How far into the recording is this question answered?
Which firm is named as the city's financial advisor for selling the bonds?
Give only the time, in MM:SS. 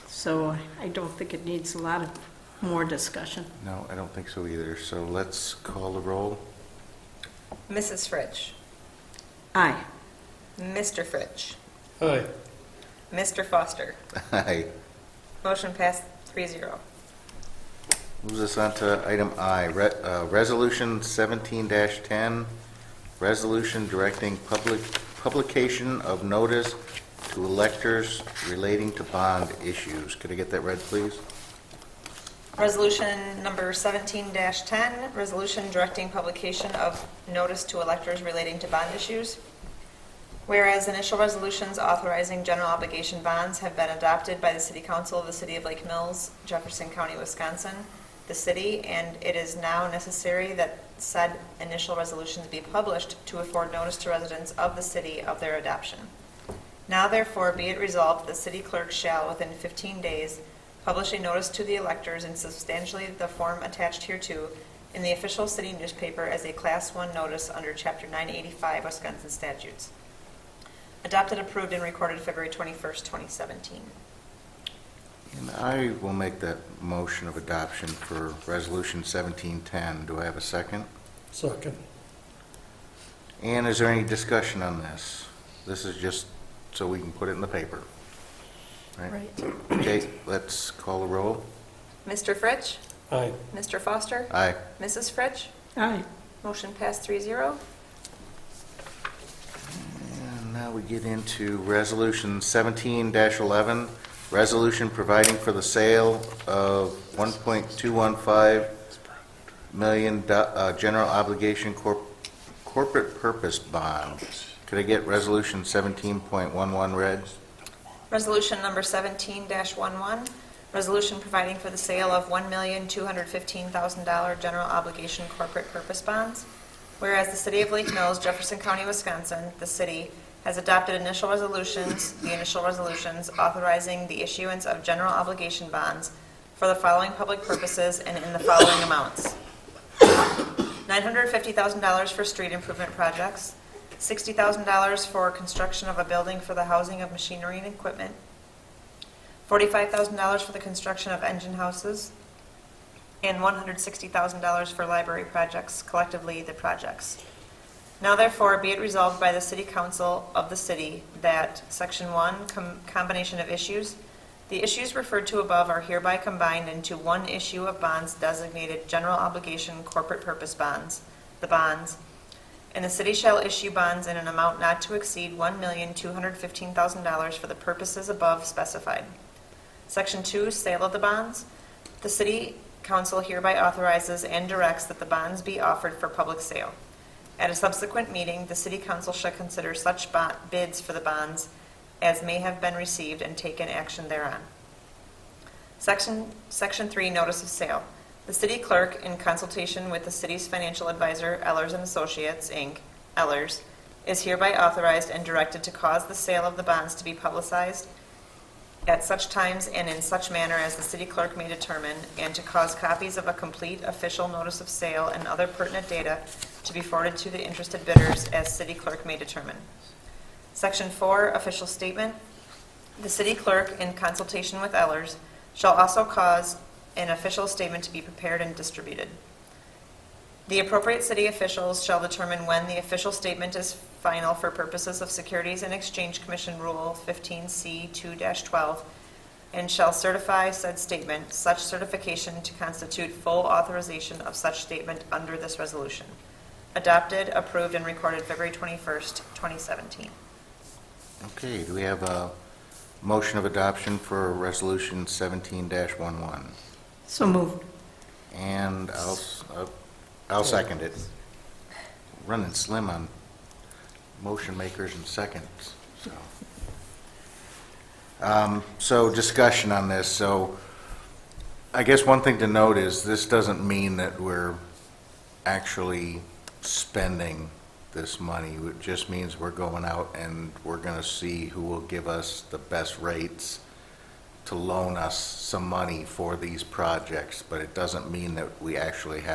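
03:21.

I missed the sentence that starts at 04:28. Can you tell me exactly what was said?
Um, So discussion on this, so I guess one thing to note is this doesn't mean that we're actually spending this money.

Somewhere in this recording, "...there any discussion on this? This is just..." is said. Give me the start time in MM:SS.
01:23.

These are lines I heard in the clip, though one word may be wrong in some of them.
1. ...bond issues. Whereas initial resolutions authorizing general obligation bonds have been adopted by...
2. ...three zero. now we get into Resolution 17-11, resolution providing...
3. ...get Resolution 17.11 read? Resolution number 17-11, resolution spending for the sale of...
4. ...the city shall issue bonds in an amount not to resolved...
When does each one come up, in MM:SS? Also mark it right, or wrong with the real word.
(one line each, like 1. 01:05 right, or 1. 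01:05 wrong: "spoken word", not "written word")
1. 00:38 right
2. 01:37 right
3. 01:54 wrong: "providing", not "spending"
4. 02:52 wrong: "exceed", not "resolved".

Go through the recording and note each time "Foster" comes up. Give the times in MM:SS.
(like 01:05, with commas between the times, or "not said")
00:13, 01:33.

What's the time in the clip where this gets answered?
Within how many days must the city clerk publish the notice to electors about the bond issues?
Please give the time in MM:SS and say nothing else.
00:59.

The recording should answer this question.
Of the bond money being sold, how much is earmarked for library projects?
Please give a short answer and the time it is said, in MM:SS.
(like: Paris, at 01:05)
$160,000, at 02:33.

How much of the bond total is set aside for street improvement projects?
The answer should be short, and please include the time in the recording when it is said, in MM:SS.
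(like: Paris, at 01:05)
$950,000, at 02:20.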